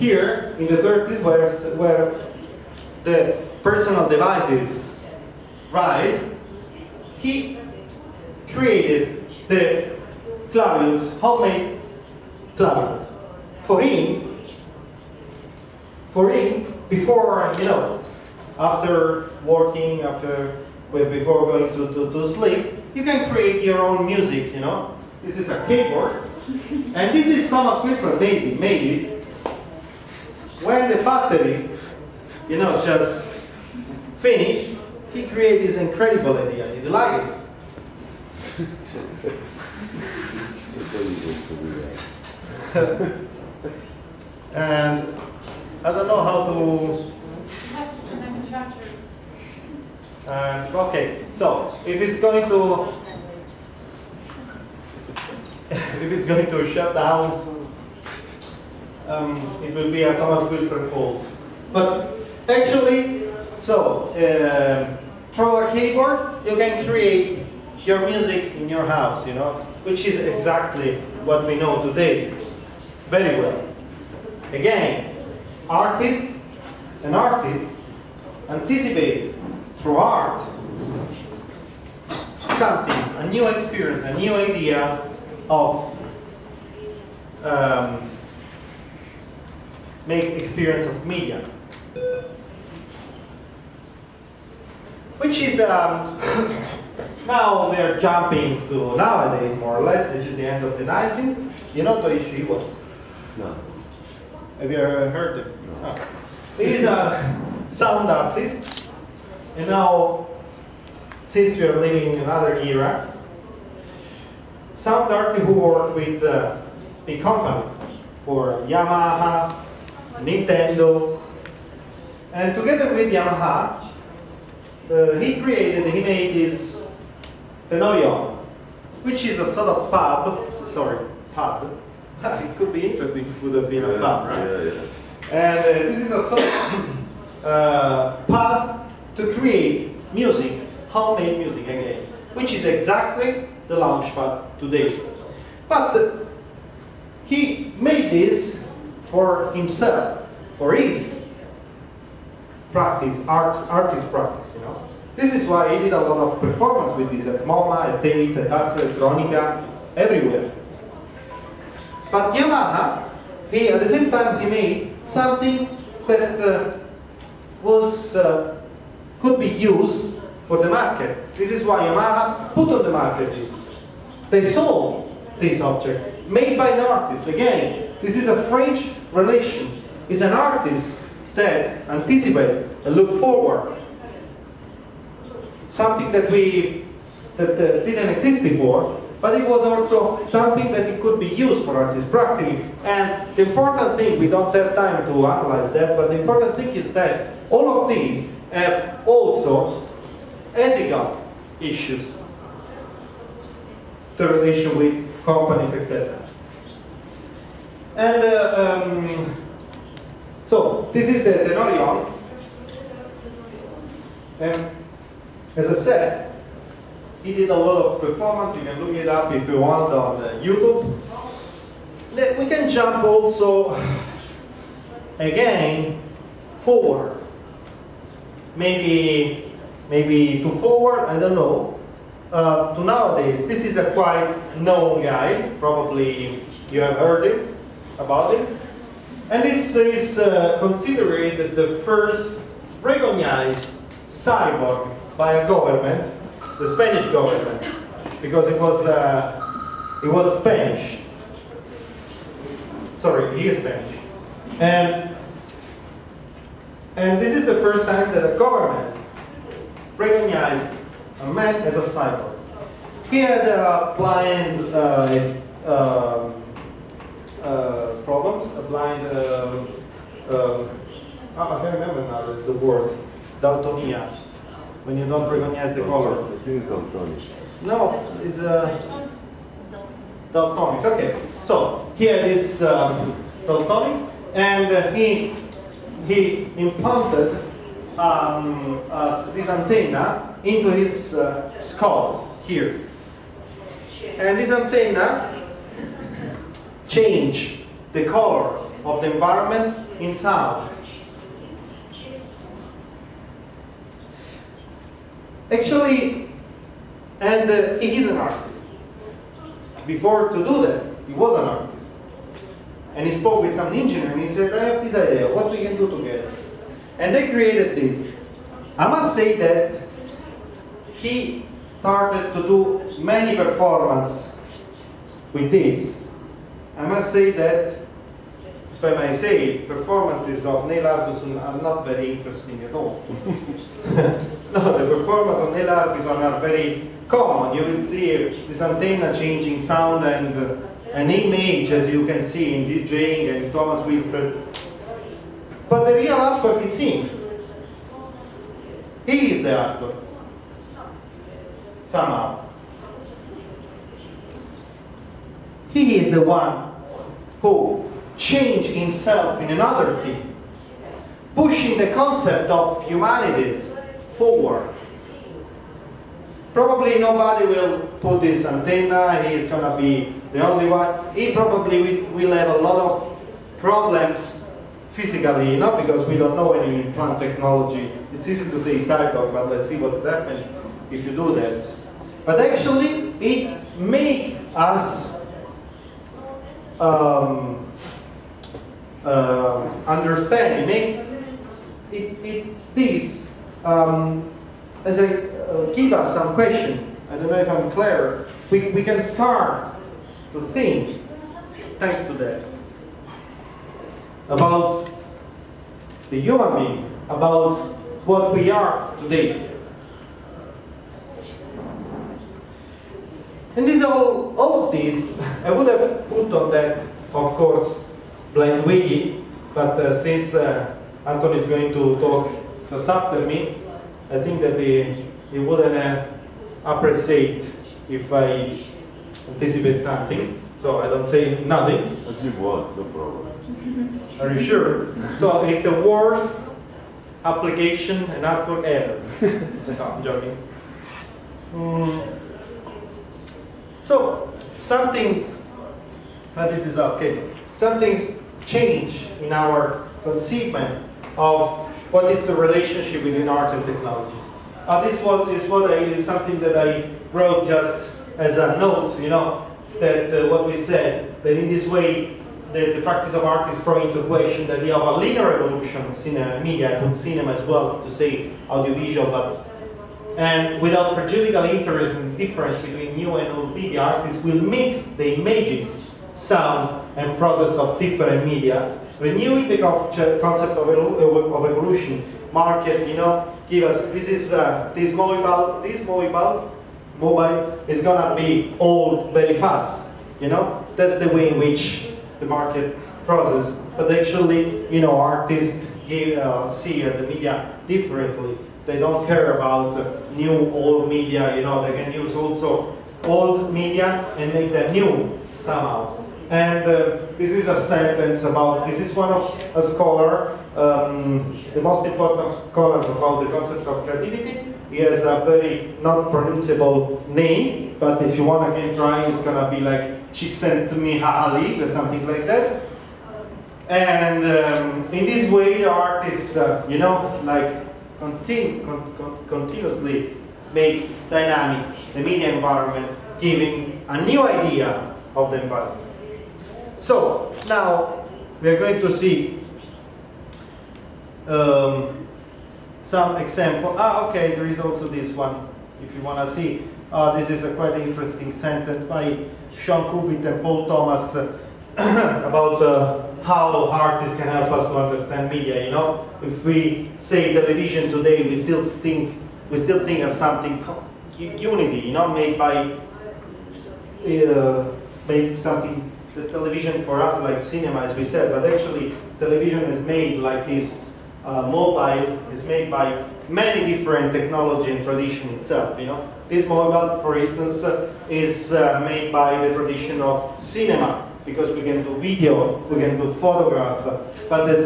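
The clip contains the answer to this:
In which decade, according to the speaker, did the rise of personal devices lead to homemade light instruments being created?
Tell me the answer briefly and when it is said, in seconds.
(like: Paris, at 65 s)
30s, at 0 s.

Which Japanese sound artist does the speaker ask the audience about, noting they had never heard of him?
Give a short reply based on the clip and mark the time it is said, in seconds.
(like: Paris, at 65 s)
Toshio Iwai, at 102 s.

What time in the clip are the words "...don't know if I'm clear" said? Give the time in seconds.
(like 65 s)
397 s.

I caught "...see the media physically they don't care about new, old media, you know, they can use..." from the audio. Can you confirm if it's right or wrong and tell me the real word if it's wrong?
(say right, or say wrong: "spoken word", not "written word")
wrong: "differently", not "physically".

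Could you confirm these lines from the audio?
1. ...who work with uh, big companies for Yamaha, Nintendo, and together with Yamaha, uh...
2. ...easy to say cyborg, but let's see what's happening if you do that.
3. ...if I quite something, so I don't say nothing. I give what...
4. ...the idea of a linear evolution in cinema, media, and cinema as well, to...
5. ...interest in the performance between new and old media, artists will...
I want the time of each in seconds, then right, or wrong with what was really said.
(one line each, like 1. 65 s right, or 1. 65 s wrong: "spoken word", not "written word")
1. 115 s right
2. 378 s right
3. 427 s wrong: "anticipate", not "quite"
4. 464 s right
5. 471 s wrong: "difference", not "performance".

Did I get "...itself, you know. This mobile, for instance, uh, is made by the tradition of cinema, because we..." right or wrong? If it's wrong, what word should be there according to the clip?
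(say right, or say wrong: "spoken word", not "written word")
right.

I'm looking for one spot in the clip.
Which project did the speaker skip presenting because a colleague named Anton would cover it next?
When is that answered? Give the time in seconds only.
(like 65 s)
418 s.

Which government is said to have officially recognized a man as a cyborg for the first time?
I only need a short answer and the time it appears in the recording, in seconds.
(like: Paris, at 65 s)
Spanish government, at 246 s.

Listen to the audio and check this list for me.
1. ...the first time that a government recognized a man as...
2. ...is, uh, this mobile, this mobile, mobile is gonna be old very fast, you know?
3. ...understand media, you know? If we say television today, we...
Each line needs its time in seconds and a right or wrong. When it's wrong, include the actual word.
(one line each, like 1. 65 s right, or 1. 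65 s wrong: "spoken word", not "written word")
1. 257 s right
2. 484 s right
3. 554 s right.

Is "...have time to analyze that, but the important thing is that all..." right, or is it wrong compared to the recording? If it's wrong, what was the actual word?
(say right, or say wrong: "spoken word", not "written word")
right.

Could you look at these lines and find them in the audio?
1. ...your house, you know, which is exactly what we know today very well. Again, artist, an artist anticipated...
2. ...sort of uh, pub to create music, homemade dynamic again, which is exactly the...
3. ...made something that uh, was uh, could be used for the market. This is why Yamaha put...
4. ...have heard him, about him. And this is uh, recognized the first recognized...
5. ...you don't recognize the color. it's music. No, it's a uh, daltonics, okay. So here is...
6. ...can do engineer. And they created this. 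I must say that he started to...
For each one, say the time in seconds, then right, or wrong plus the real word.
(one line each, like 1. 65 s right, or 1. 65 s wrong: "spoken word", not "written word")
1. 68 s right
2. 136 s wrong: "music", not "dynamic"
3. 164 s right
4. 236 s wrong: "considered", not "recognized"
5. 274 s wrong: "daltonic", not "music"
6. 315 s wrong: "together", not "engineer".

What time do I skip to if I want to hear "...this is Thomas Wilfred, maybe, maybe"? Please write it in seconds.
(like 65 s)
27 s.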